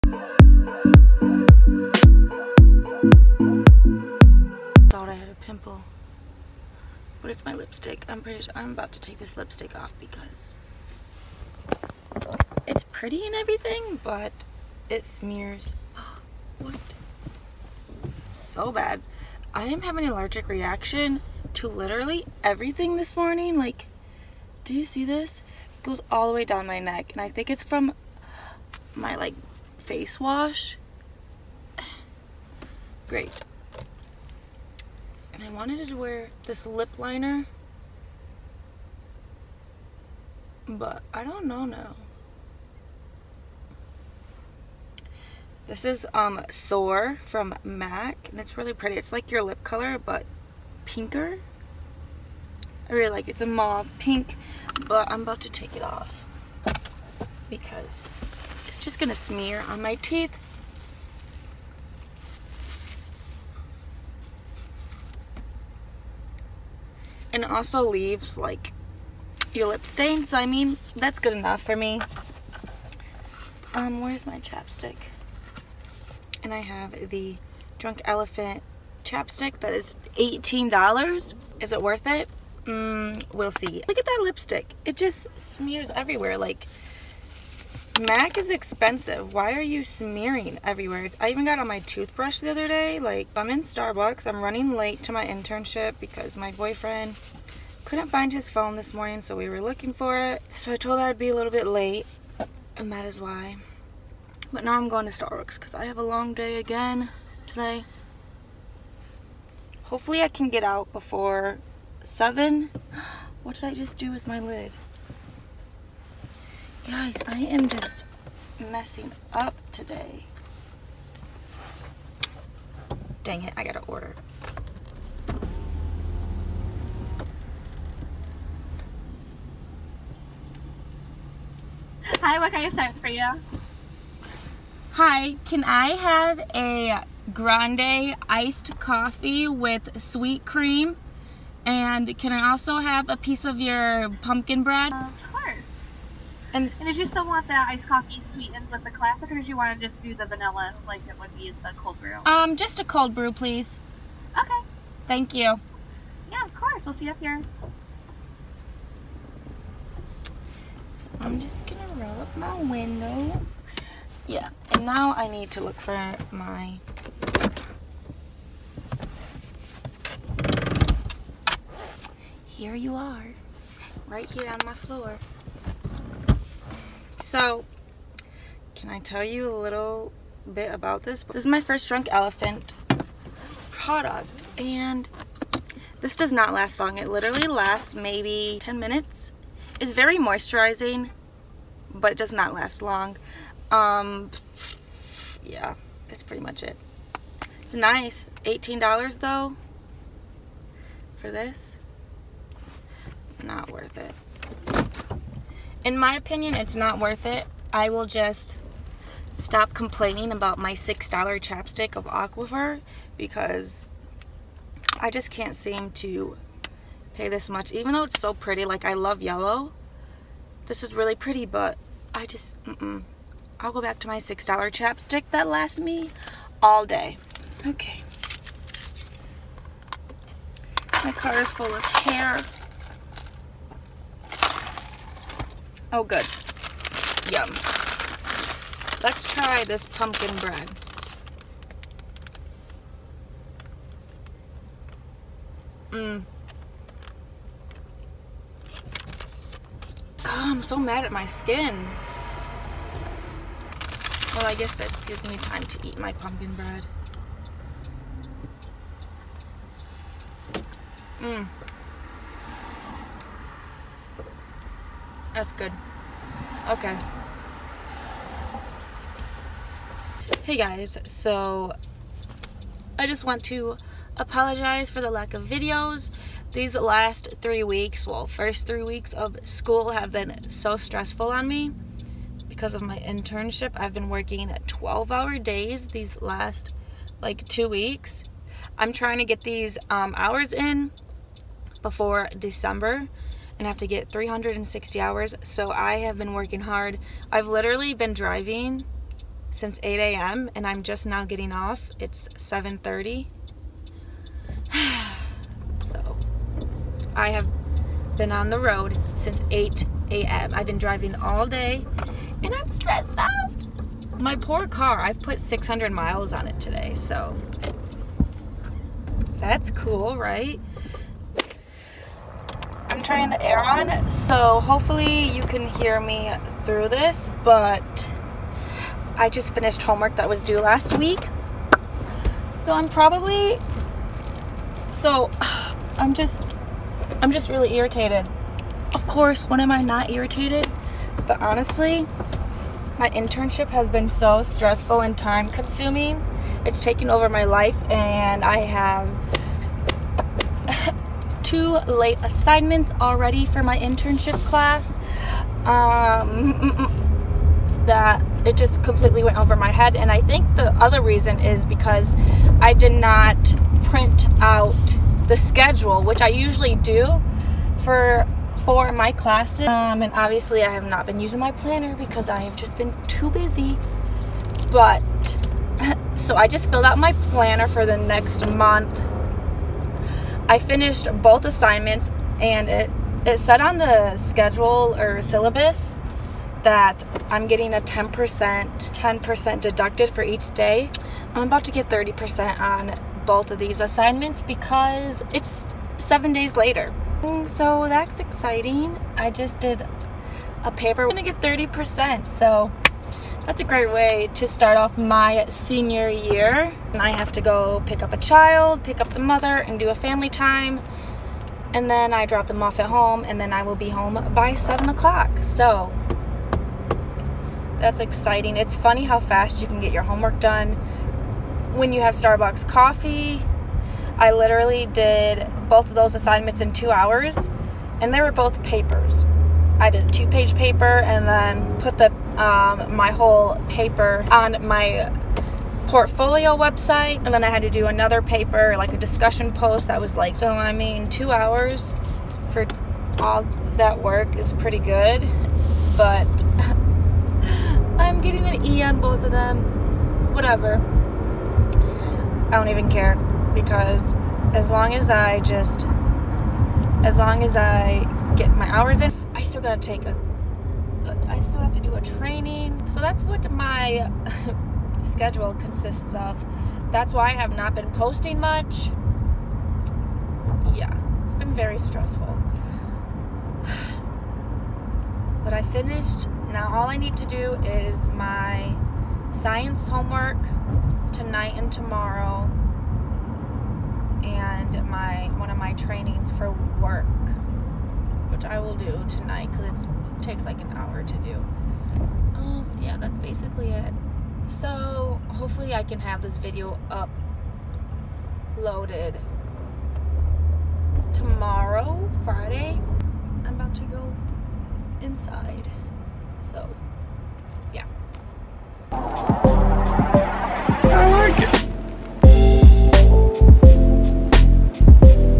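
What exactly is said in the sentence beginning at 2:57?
So, can I tell you a little bit about this?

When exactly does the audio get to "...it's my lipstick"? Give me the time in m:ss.
0:07.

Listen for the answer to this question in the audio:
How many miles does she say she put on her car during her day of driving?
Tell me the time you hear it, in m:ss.
5:15.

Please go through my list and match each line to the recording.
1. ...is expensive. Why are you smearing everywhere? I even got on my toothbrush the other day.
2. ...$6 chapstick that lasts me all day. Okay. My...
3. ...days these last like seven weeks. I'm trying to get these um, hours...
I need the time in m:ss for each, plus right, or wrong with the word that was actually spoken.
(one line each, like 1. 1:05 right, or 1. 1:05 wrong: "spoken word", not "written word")
1. 1:28 right
2. 3:44 right
3. 4:45 wrong: "two", not "seven".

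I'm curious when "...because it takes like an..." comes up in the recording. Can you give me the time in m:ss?
8:09.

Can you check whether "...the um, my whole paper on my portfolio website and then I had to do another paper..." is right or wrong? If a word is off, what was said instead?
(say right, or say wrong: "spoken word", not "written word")
right.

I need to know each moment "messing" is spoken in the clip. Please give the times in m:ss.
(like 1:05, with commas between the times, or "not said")
1:58.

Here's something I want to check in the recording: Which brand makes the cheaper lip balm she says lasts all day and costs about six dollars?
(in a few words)
Aquaphor.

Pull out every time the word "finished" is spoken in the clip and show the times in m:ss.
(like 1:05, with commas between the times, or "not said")
5:29, 6:20, 7:55.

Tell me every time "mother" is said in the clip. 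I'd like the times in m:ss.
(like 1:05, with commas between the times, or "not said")
6:49.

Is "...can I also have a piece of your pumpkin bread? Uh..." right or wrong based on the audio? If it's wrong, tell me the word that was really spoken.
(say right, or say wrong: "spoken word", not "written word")
right.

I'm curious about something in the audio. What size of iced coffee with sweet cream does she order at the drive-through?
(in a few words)
Grande.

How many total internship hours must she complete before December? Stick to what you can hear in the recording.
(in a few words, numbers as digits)
360.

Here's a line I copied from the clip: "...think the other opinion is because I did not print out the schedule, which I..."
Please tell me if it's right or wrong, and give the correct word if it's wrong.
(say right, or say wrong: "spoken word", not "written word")
wrong: "reason", not "opinion".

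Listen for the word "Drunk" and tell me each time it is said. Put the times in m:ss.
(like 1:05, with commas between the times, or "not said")
1:17, 3:01.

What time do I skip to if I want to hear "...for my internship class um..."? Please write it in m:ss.
5:53.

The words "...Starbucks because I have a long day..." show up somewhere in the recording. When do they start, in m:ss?
1:45.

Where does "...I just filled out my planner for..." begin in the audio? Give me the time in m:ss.
6:16.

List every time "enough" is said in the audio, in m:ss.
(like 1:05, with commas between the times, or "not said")
1:11.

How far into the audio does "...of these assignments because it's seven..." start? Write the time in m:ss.
6:33.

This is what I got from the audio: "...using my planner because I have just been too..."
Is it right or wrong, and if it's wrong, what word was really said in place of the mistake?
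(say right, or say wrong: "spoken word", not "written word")
right.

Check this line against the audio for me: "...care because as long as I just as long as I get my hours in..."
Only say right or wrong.
right.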